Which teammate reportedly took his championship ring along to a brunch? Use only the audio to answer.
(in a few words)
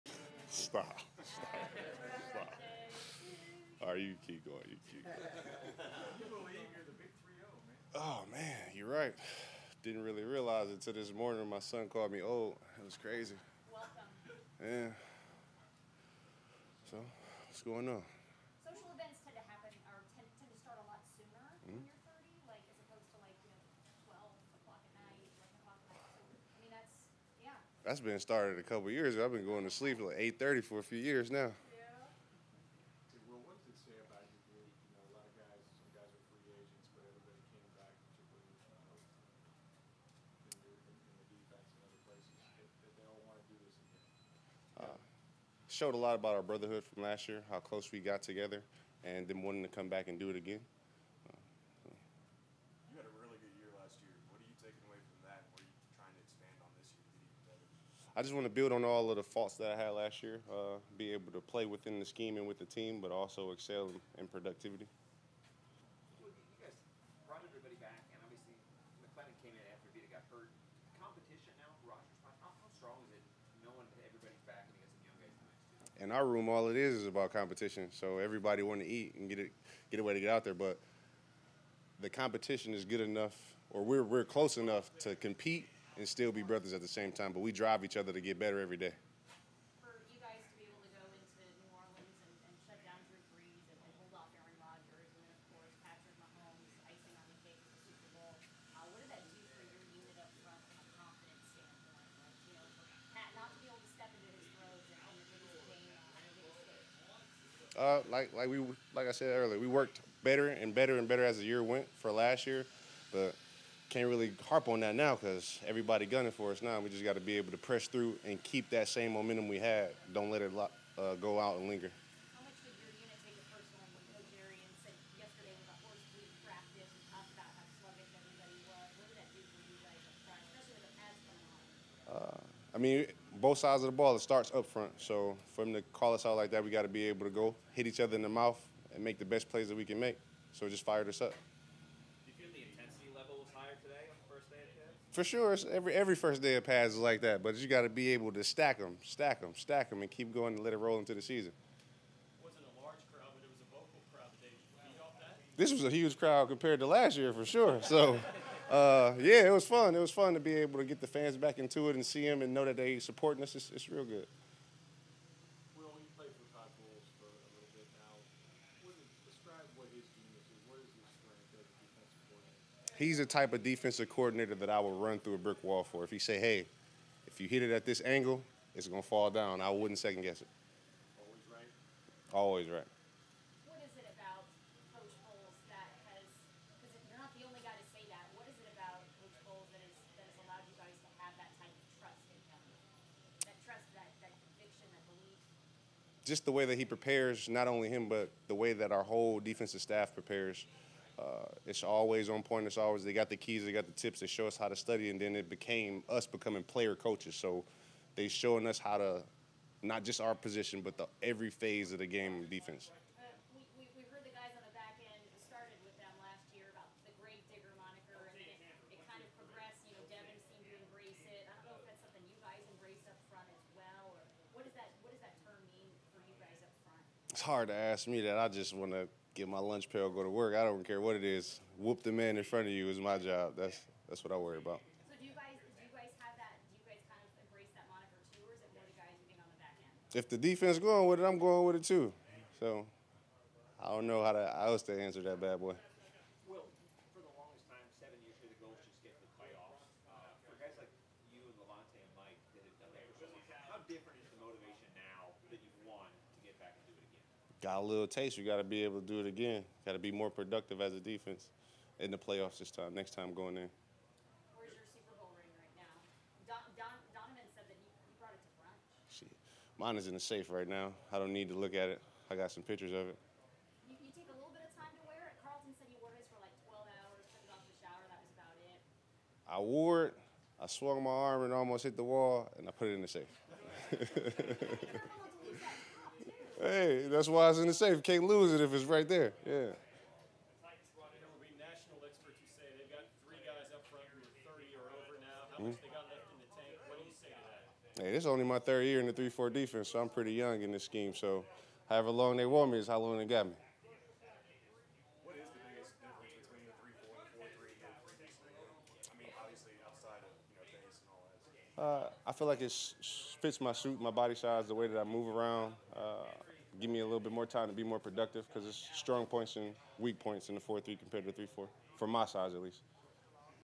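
Donovan.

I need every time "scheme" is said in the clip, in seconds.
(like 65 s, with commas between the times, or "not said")
62 s, 300 s.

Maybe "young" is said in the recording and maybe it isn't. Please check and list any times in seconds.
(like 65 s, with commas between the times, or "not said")
75 s, 300 s.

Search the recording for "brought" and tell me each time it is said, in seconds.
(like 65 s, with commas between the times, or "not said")
67 s, 268 s.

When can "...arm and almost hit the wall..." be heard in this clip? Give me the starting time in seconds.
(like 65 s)
281 s.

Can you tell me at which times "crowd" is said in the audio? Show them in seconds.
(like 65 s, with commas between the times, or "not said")
156 s.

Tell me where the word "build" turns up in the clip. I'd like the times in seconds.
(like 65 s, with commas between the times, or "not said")
58 s.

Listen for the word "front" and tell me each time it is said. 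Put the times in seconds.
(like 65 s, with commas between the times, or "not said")
134 s, 232 s.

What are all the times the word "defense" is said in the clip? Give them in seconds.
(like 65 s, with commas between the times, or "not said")
240 s, 260 s, 299 s.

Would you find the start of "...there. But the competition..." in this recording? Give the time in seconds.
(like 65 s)
80 s.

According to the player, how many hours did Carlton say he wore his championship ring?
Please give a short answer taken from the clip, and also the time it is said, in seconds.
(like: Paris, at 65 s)
12, at 276 s.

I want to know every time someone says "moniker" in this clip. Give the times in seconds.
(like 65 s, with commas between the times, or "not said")
237 s.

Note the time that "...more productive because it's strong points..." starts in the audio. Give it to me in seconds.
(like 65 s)
317 s.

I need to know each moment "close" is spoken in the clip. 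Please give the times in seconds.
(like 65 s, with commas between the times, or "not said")
84 s.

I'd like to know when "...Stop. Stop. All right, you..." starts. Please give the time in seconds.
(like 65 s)
1 s.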